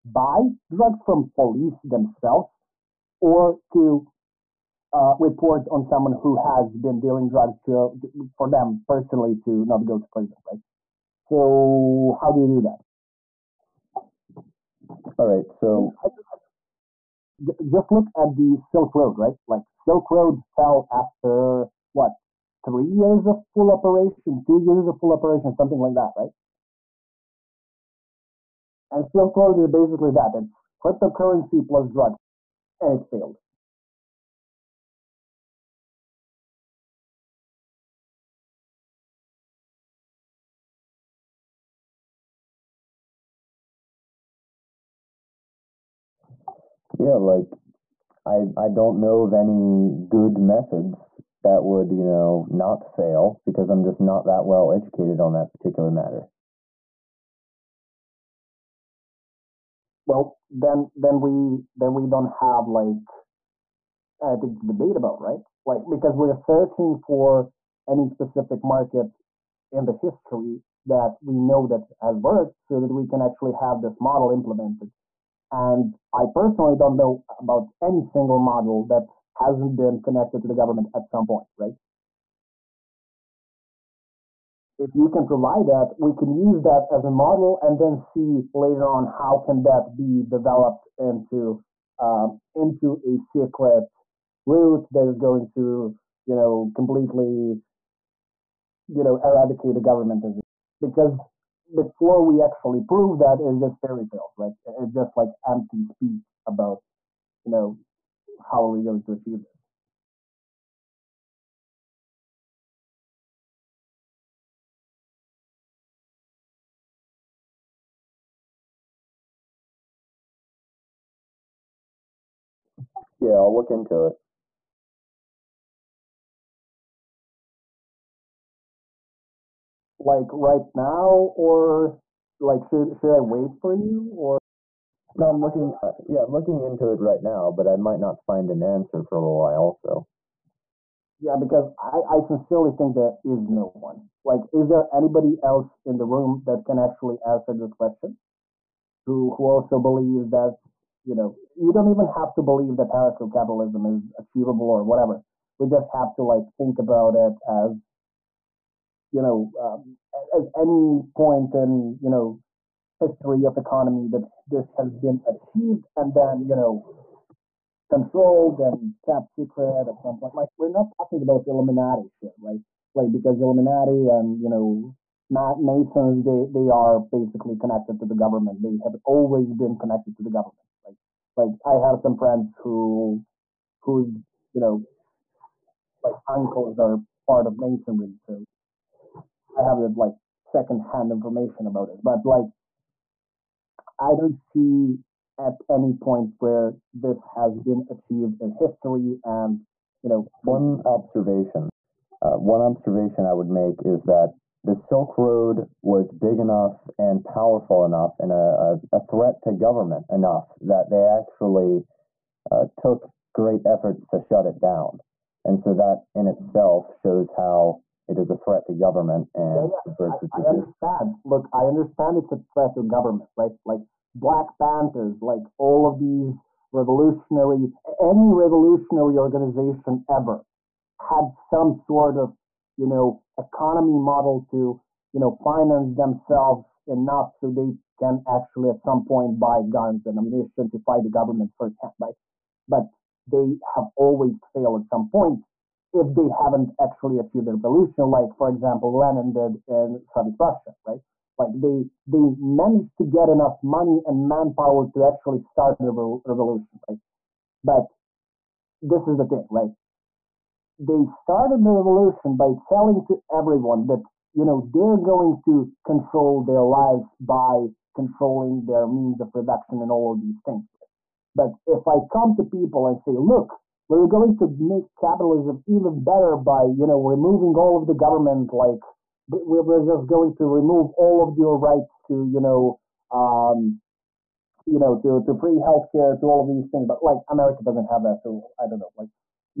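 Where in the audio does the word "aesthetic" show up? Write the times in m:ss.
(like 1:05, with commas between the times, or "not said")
not said.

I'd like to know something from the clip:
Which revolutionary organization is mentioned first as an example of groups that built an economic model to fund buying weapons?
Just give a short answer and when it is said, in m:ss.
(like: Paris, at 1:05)
Black Panthers, at 3:44.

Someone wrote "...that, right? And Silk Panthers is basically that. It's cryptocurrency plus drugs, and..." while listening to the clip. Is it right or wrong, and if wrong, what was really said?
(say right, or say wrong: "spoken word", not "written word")
wrong: "Road", not "Panthers".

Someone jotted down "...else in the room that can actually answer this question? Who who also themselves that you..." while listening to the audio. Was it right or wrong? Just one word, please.
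wrong.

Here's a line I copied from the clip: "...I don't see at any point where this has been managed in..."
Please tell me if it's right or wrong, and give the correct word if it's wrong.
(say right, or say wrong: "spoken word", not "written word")
wrong: "achieved", not "managed".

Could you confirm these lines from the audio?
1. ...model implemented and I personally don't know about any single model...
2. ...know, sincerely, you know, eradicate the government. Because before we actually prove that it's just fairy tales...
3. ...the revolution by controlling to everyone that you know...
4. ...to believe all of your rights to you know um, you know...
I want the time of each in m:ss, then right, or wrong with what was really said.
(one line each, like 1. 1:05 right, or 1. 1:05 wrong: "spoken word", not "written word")
1. 1:14 right
2. 1:36 wrong: "completely", not "sincerely"
3. 4:21 wrong: "telling", not "controlling"
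4. 4:40 wrong: "remove", not "believe".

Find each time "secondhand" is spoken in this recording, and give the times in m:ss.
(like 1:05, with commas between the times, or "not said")
3:10.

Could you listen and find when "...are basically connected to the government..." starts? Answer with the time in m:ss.
2:56.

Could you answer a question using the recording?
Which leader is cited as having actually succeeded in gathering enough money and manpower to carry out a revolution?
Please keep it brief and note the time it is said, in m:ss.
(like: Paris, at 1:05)
Lenin, at 4:08.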